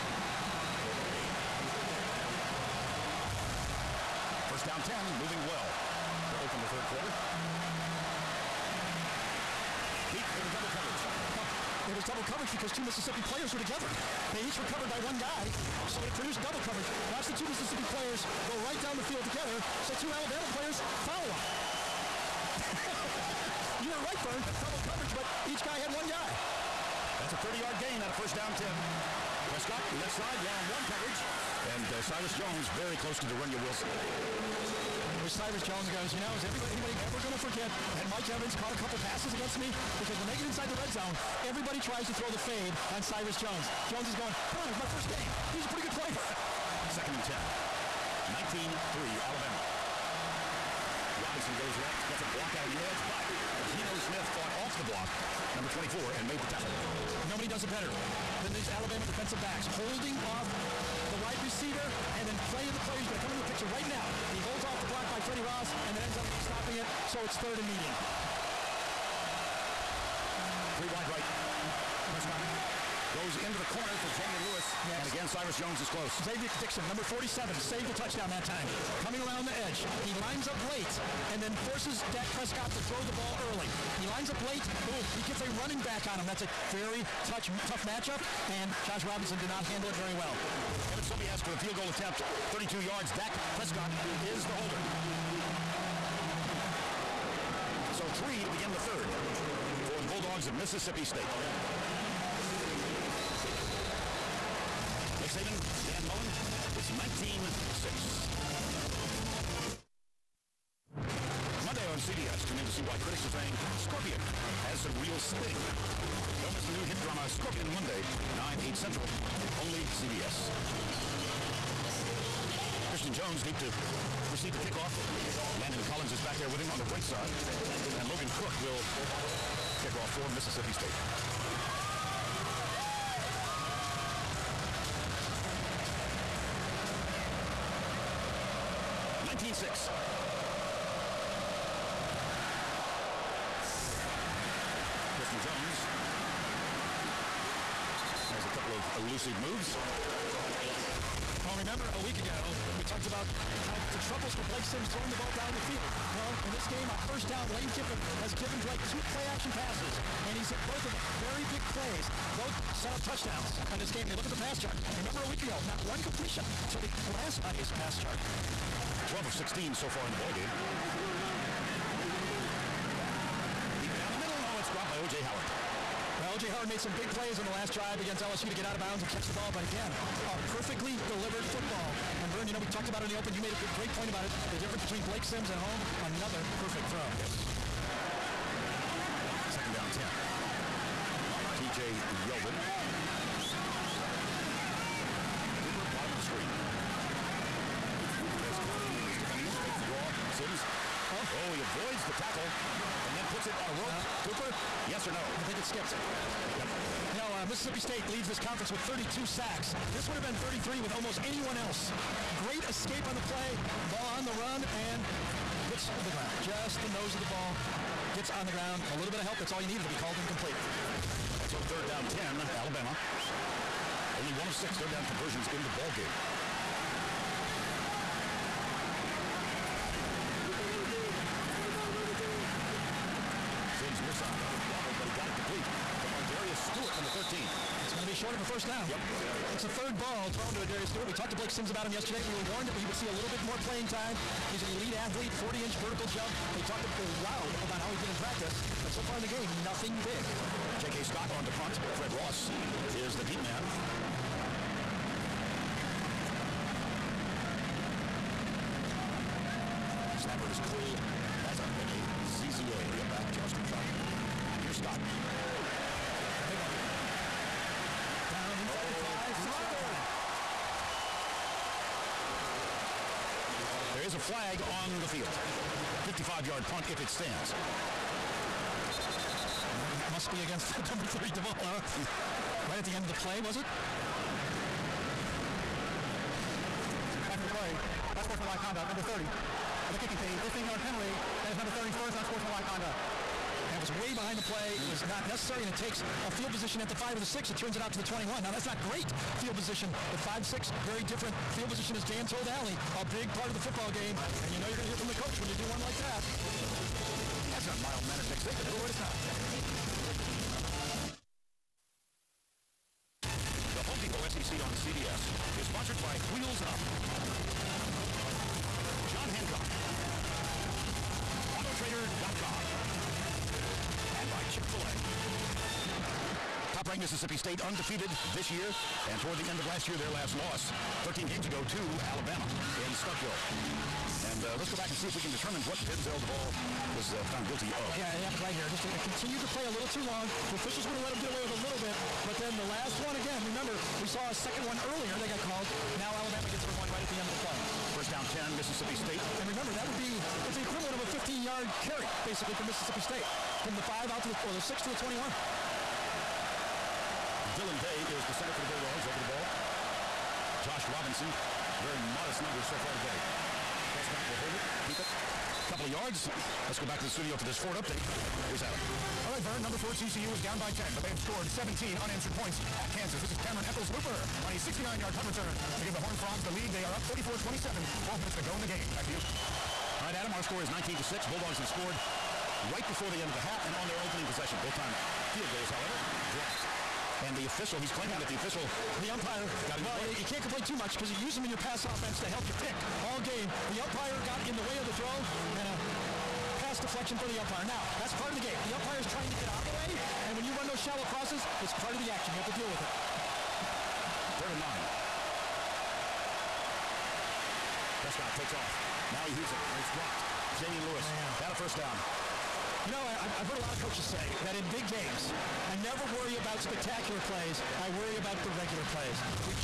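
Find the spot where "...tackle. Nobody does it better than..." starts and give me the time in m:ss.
0:56.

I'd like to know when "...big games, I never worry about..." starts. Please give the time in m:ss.
6:54.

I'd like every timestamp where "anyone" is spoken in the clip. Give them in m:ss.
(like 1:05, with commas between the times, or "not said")
3:31.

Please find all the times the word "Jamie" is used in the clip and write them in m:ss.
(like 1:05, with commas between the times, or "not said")
1:14.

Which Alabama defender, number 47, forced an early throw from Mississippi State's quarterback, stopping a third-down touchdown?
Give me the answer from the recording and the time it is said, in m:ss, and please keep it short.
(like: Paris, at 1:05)
Xzavier Dickson, at 1:16.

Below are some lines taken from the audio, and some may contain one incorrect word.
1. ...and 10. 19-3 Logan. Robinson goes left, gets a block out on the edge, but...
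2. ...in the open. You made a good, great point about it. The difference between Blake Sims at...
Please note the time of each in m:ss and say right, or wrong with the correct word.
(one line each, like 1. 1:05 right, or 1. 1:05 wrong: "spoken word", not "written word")
1. 0:47 wrong: "Alabama", not "Logan"
2. 3:03 right.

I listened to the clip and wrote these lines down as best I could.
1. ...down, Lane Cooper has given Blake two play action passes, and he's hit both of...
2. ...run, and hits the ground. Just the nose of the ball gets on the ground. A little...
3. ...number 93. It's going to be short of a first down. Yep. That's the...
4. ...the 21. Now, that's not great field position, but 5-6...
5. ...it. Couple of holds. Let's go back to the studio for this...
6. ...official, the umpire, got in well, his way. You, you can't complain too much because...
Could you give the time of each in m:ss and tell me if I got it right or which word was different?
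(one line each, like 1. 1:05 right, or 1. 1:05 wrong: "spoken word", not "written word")
1. 2:37 wrong: "Kiffin", not "Cooper"
2. 3:34 right
3. 3:56 wrong: "13", not "93"
4. 4:57 right
5. 6:04 wrong: "yards", not "holds"
6. 6:28 right.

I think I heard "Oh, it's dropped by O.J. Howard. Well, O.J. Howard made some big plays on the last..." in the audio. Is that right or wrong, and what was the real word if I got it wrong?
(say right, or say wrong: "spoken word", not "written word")
right.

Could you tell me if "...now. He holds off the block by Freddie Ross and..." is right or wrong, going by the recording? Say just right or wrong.
right.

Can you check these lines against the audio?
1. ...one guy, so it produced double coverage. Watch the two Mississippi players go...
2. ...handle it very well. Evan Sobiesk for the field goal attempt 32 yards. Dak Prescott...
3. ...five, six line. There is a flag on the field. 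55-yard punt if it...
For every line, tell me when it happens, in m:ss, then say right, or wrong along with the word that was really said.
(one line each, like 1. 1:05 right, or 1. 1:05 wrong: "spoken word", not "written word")
1. 0:15 right
2. 1:29 right
3. 4:29 right.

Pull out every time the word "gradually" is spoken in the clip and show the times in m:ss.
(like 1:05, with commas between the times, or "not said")
not said.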